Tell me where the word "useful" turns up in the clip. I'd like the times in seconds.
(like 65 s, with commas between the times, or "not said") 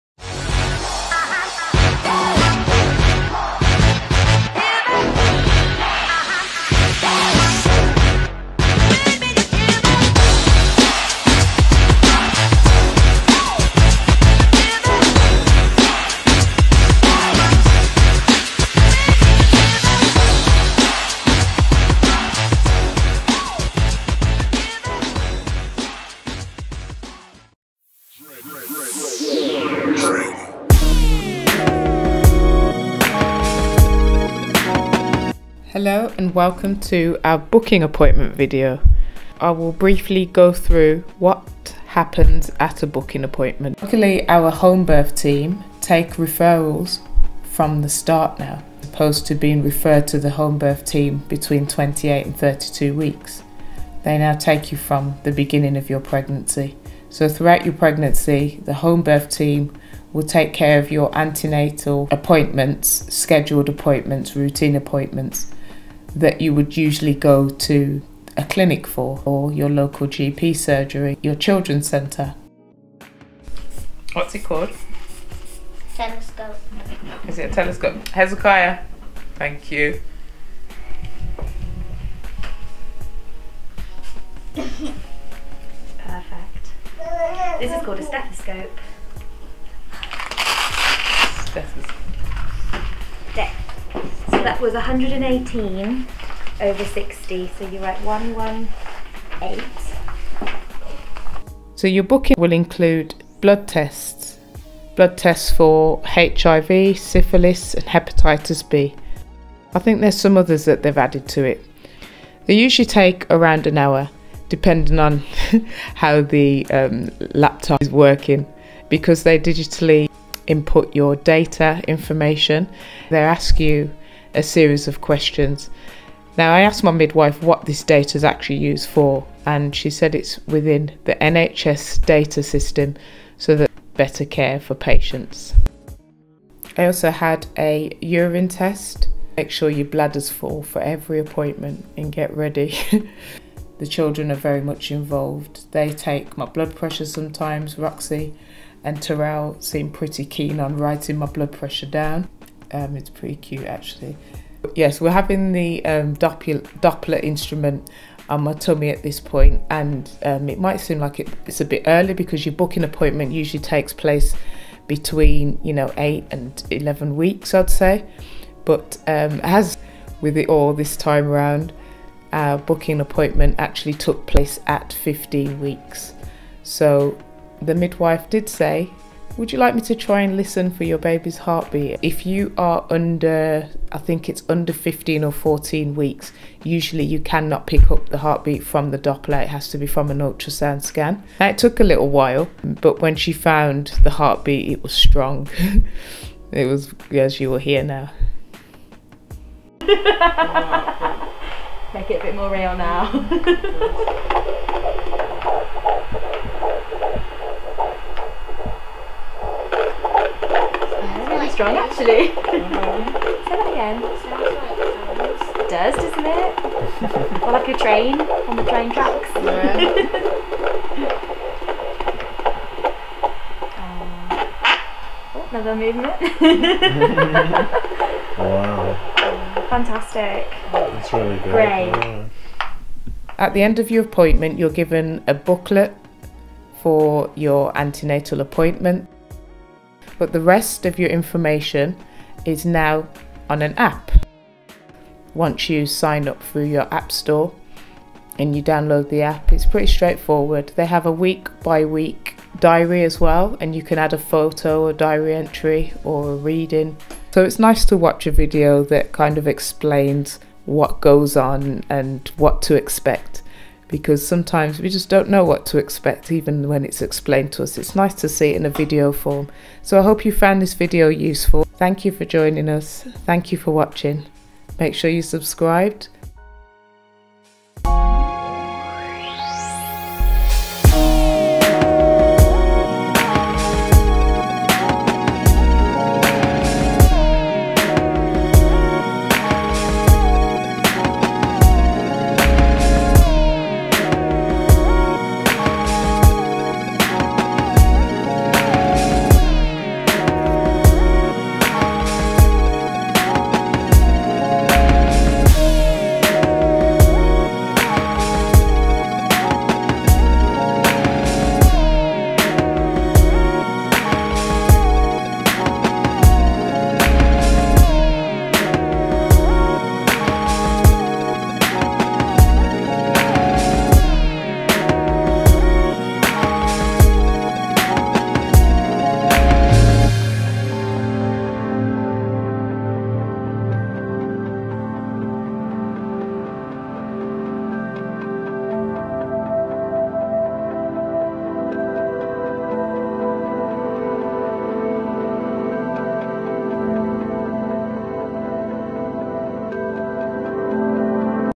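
271 s.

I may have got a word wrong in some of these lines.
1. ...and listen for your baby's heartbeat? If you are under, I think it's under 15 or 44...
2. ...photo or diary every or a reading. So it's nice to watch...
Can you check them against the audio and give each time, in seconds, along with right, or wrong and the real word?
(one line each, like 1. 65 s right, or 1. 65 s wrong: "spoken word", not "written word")
1. 180 s wrong: "14", not "44"
2. 254 s wrong: "entry", not "every".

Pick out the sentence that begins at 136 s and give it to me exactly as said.
I also had a urine test.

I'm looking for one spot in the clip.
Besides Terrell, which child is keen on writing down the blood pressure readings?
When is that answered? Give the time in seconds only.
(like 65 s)
147 s.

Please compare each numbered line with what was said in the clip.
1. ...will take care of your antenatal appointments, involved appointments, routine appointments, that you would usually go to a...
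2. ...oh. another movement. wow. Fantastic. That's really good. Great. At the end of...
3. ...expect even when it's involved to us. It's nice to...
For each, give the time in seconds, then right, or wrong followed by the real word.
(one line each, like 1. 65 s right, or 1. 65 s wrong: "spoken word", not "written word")
1. 60 s wrong: "scheduled", not "involved"
2. 223 s right
3. 265 s wrong: "explained", not "involved".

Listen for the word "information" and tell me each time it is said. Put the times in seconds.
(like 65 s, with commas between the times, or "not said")
121 s, 241 s.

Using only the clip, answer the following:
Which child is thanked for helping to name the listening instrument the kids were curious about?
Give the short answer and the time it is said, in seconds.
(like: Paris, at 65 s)
Hezekiah, at 78 s.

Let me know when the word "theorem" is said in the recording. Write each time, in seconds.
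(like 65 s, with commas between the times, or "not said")
not said.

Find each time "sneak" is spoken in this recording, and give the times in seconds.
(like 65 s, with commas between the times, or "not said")
not said.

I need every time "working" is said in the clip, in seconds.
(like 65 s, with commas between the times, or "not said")
117 s.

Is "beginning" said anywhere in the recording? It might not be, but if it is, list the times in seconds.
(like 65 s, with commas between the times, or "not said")
55 s.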